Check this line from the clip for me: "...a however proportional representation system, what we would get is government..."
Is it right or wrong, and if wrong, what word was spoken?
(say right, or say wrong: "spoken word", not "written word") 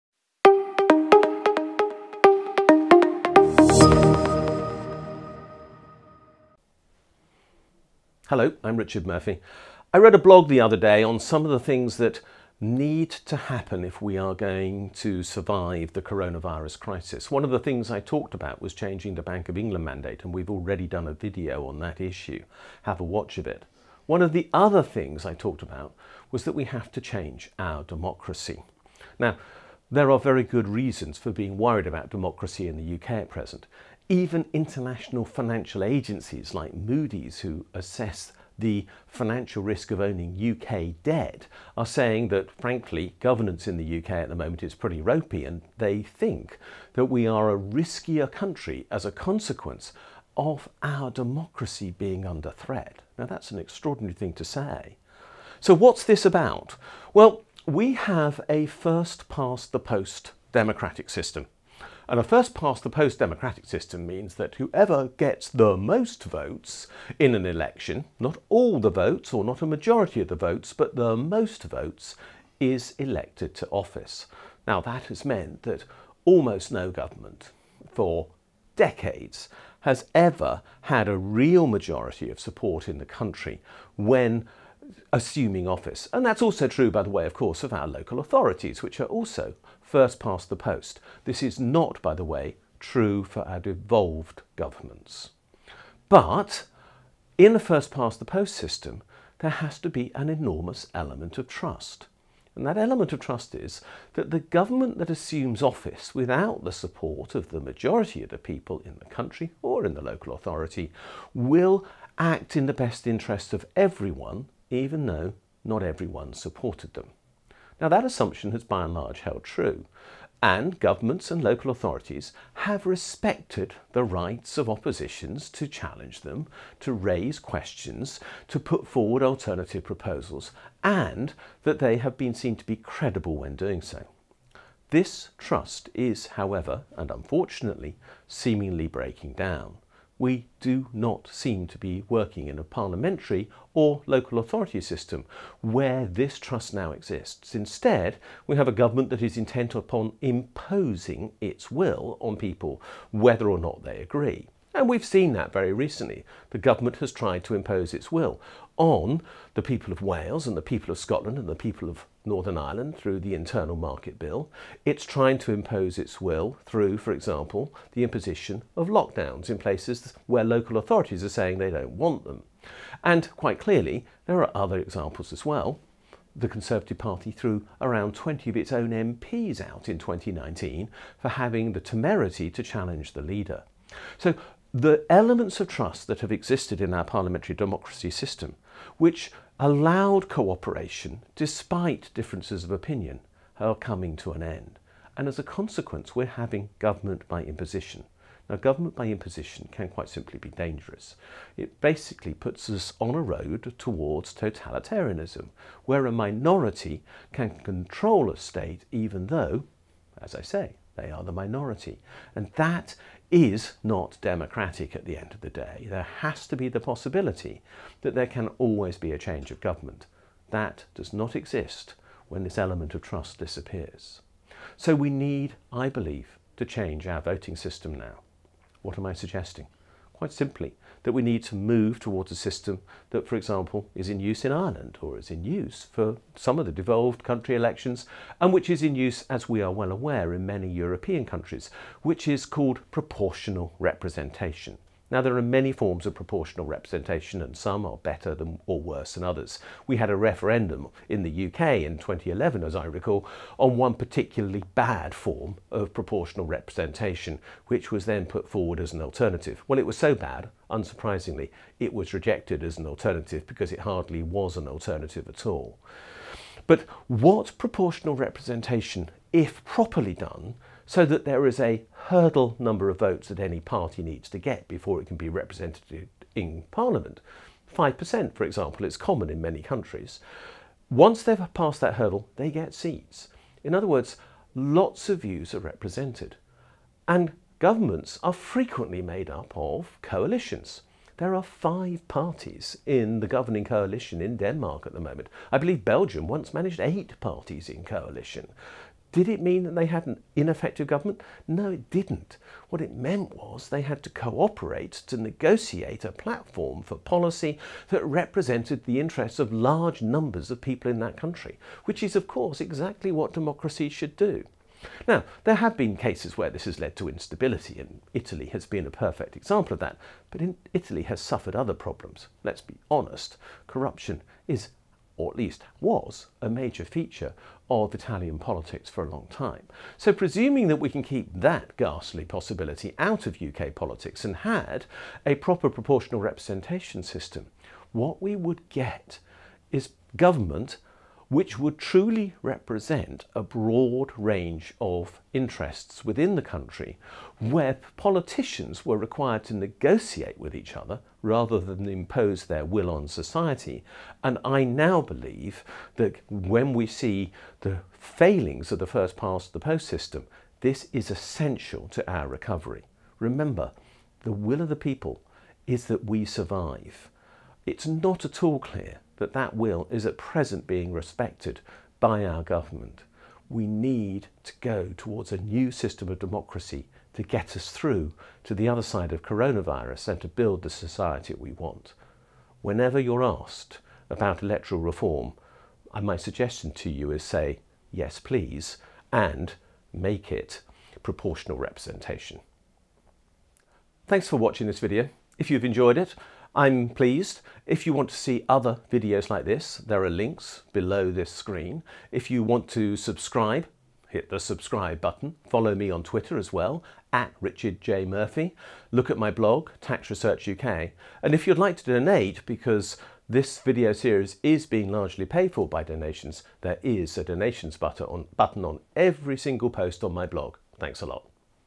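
wrong: "proper", not "however".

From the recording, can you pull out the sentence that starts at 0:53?
Now, that's an extraordinary thing to say.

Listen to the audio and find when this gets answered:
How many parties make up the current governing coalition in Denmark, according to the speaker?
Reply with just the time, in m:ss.
4:51.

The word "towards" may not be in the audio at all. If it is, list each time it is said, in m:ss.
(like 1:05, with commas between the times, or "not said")
3:23, 3:51, 6:14.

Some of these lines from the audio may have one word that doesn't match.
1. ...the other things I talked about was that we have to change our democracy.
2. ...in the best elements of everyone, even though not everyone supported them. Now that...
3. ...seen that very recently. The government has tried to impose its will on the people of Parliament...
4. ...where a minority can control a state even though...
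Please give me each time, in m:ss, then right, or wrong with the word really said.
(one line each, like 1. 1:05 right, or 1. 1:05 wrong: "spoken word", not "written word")
1. 0:24 right
2. 1:52 wrong: "interests", not "elements"
3. 2:35 wrong: "Wales", not "Parliament"
4. 3:25 right.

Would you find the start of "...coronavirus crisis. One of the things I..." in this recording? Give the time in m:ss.
0:16.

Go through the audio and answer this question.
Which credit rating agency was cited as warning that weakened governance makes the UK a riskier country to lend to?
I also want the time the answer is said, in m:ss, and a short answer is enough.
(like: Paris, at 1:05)
Moody's, at 0:36.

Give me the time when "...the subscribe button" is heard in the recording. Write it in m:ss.
6:44.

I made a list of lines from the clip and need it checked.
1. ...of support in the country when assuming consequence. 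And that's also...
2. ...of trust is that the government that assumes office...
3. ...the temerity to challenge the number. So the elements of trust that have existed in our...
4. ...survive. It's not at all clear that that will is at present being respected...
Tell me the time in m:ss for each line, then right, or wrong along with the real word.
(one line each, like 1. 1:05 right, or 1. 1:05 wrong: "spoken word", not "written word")
1. 1:22 wrong: "office", not "consequence"
2. 1:43 right
3. 3:01 wrong: "leader", not "number"
4. 6:06 right.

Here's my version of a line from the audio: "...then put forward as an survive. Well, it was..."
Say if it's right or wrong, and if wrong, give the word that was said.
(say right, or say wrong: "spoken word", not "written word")
wrong: "alternative", not "survive".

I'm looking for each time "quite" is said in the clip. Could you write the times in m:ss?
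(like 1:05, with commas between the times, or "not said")
2:53, 3:19, 3:50.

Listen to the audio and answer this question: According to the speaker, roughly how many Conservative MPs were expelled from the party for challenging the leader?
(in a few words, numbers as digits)
20.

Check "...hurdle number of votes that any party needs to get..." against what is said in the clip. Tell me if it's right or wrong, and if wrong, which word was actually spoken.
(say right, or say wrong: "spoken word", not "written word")
right.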